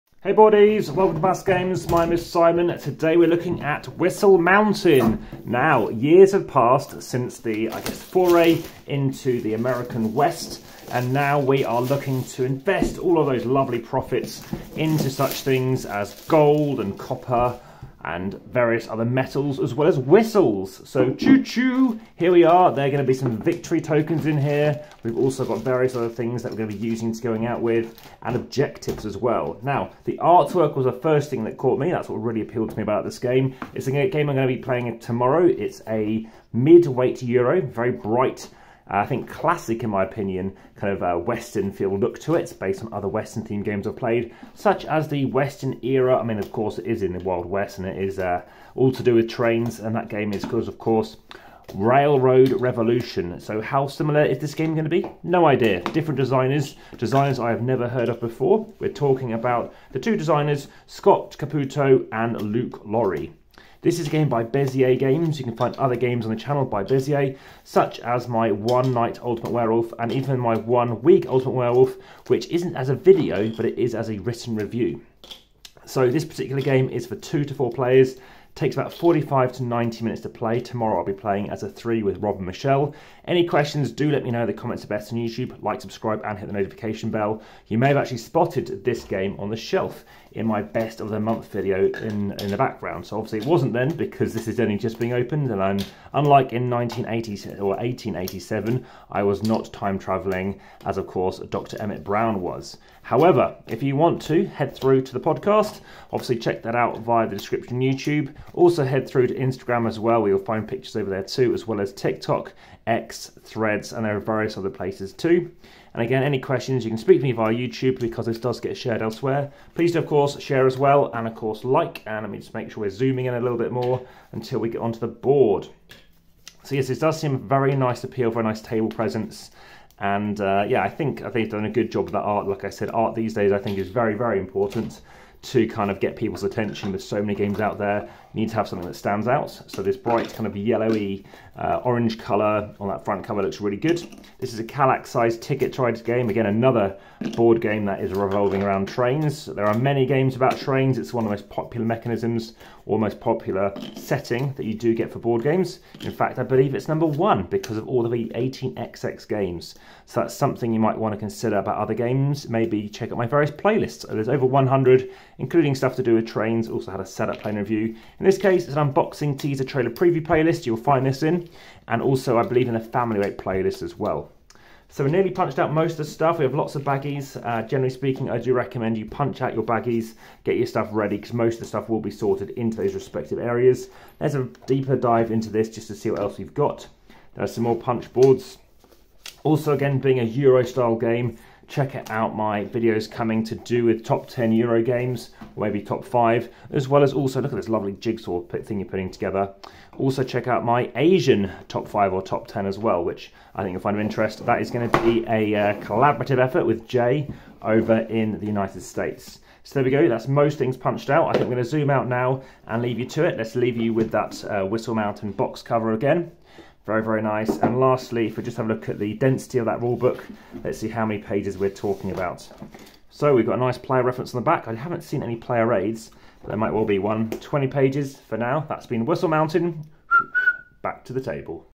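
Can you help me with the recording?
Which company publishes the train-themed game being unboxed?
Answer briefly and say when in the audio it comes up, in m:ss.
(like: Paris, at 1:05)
Bezier Games, at 1:04.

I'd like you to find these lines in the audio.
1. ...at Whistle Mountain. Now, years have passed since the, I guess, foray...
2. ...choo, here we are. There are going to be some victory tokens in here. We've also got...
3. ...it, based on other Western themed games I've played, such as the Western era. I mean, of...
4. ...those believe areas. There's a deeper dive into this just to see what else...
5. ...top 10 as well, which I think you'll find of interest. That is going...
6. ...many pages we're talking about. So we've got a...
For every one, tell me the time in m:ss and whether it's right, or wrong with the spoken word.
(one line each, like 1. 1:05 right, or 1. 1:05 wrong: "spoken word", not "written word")
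1. 0:03 right
2. 0:21 right
3. 0:42 right
4. 3:02 wrong: "respective", not "believe"
5. 3:22 right
6. 3:41 right.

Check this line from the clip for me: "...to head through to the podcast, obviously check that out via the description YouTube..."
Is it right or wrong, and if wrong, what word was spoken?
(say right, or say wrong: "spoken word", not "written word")
right.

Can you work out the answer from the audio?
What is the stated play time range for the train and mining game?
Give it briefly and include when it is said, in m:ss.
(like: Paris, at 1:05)
45 to 90 minutes, at 1:18.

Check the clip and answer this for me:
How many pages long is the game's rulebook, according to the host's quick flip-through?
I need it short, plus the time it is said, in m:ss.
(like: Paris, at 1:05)
20, at 3:47.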